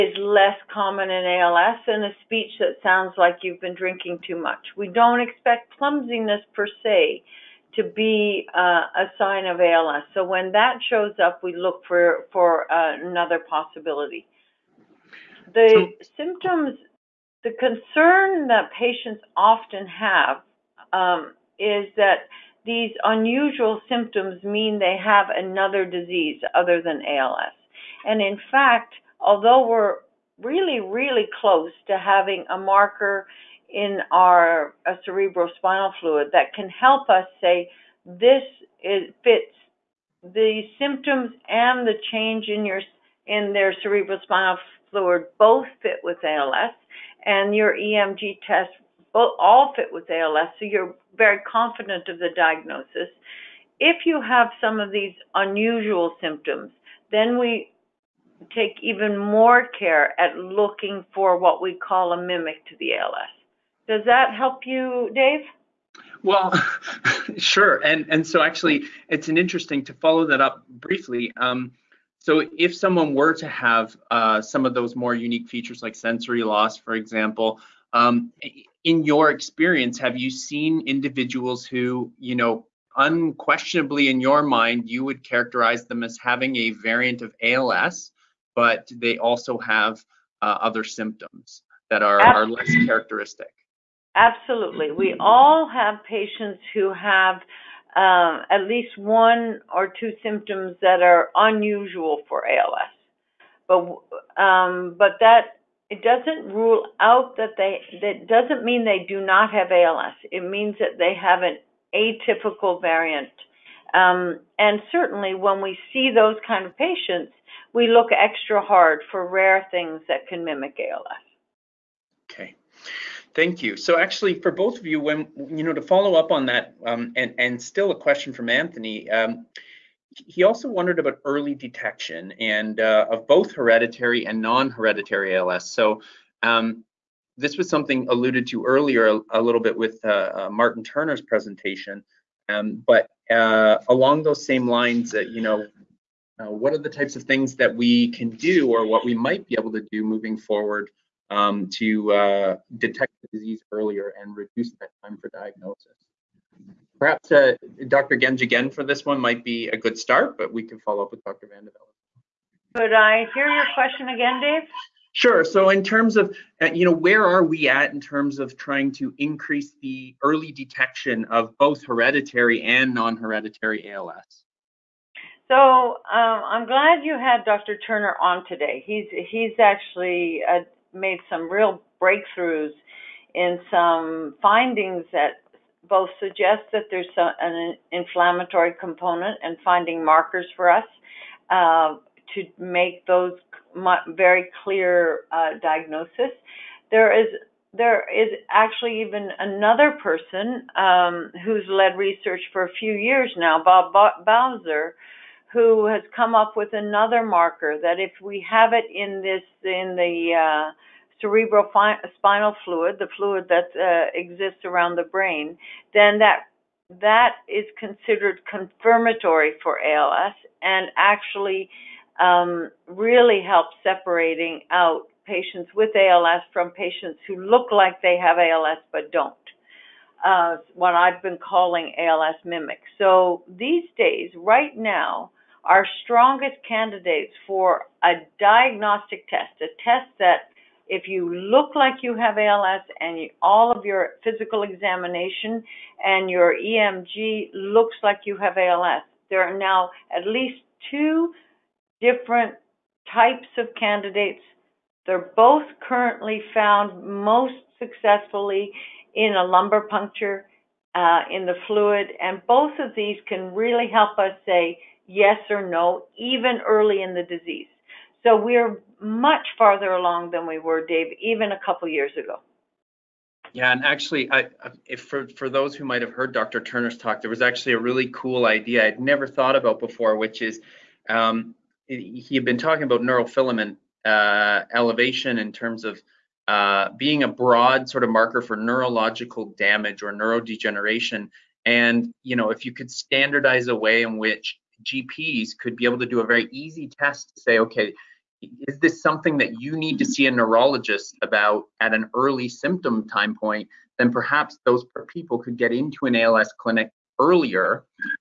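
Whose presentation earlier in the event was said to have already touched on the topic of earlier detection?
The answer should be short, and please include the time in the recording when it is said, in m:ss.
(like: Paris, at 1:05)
Martin Turner, at 2:20.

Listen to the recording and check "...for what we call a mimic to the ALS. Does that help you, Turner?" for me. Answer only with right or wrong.
wrong.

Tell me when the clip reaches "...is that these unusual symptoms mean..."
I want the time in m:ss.
0:21.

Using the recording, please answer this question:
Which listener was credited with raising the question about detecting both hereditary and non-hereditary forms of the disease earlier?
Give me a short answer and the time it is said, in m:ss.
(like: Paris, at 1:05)
Anthony, at 2:08.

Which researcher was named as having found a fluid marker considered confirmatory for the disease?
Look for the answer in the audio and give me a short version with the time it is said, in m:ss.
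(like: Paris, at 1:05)
Bob Bowser, at 3:23.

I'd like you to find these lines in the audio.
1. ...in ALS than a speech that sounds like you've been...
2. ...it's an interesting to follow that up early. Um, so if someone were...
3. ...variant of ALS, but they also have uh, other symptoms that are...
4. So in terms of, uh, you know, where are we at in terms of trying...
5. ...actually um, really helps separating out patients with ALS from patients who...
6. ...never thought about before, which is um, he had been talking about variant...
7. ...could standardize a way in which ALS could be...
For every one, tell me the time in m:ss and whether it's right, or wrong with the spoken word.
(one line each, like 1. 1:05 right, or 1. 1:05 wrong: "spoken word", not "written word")
1. 0:01 right
2. 1:09 wrong: "briefly", not "early"
3. 1:26 right
4. 2:45 right
5. 3:40 right
6. 4:38 wrong: "neurofilament", not "variant"
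7. 4:52 wrong: "GPs", not "ALS".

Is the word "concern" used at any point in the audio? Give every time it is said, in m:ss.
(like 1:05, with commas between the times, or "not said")
0:17.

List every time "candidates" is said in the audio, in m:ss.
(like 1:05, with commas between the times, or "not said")
3:56, 4:13.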